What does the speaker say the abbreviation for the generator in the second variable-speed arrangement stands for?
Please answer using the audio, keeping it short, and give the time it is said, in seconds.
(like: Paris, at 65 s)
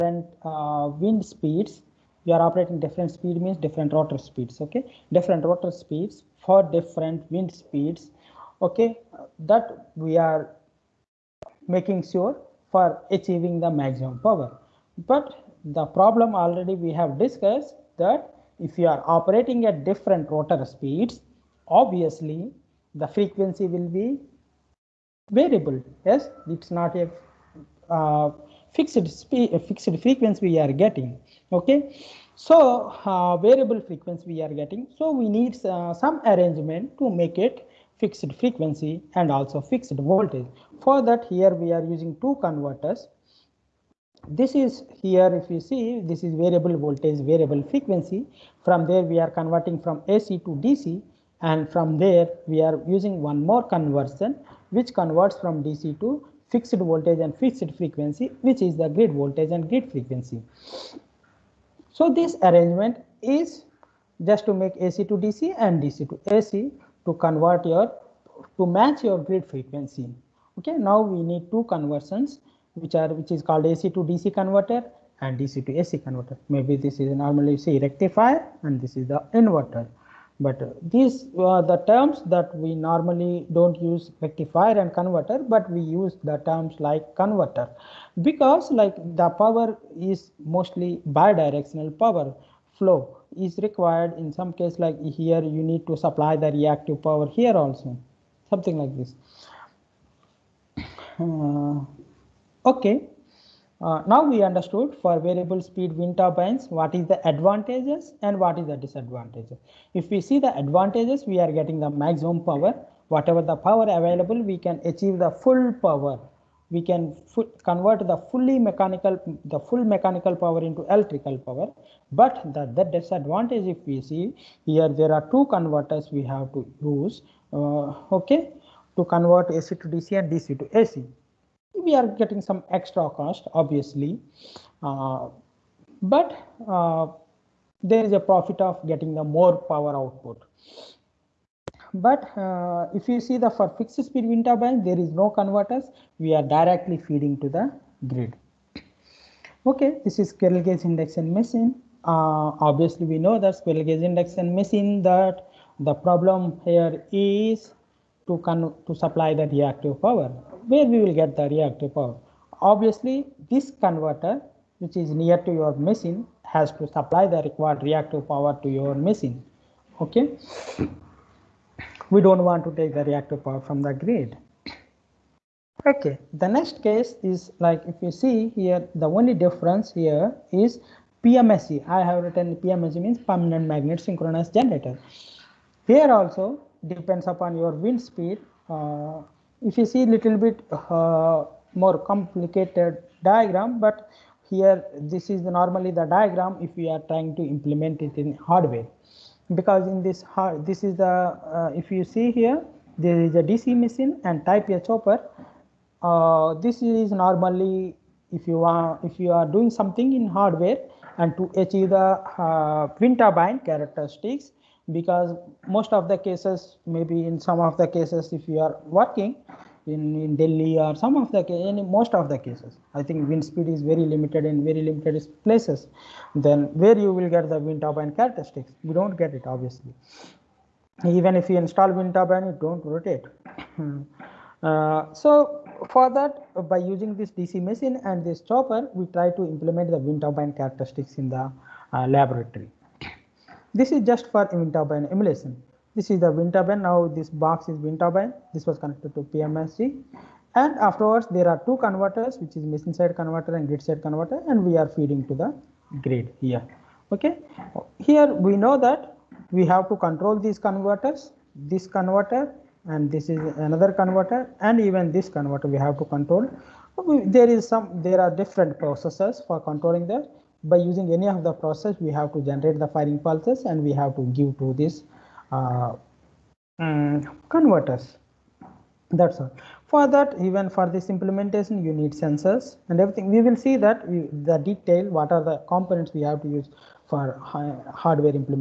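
Permanent magnet synchronous generator, at 183 s.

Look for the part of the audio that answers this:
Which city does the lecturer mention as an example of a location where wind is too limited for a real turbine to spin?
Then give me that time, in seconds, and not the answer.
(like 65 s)
220 s.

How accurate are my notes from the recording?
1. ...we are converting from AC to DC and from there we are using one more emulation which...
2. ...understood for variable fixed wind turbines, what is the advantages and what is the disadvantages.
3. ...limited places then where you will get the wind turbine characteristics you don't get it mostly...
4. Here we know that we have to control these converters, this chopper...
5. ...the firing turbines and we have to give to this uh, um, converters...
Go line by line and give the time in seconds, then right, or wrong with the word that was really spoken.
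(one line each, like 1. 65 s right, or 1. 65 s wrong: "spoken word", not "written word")
1. 49 s wrong: "conversion", not "emulation"
2. 104 s wrong: "speed", not "fixed"
3. 224 s wrong: "obviously", not "mostly"
4. 257 s wrong: "converter", not "chopper"
5. 272 s wrong: "pulses", not "turbines".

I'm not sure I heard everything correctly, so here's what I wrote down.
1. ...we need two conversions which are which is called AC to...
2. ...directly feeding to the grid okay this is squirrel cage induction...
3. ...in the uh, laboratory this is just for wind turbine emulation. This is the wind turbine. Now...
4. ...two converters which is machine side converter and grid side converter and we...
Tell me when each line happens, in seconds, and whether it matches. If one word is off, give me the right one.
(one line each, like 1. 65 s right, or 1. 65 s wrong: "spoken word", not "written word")
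1. 71 s right
2. 146 s right
3. 241 s right
4. 251 s right.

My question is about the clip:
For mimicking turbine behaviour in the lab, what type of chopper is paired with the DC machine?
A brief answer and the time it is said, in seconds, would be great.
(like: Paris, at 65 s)
Type A, at 204 s.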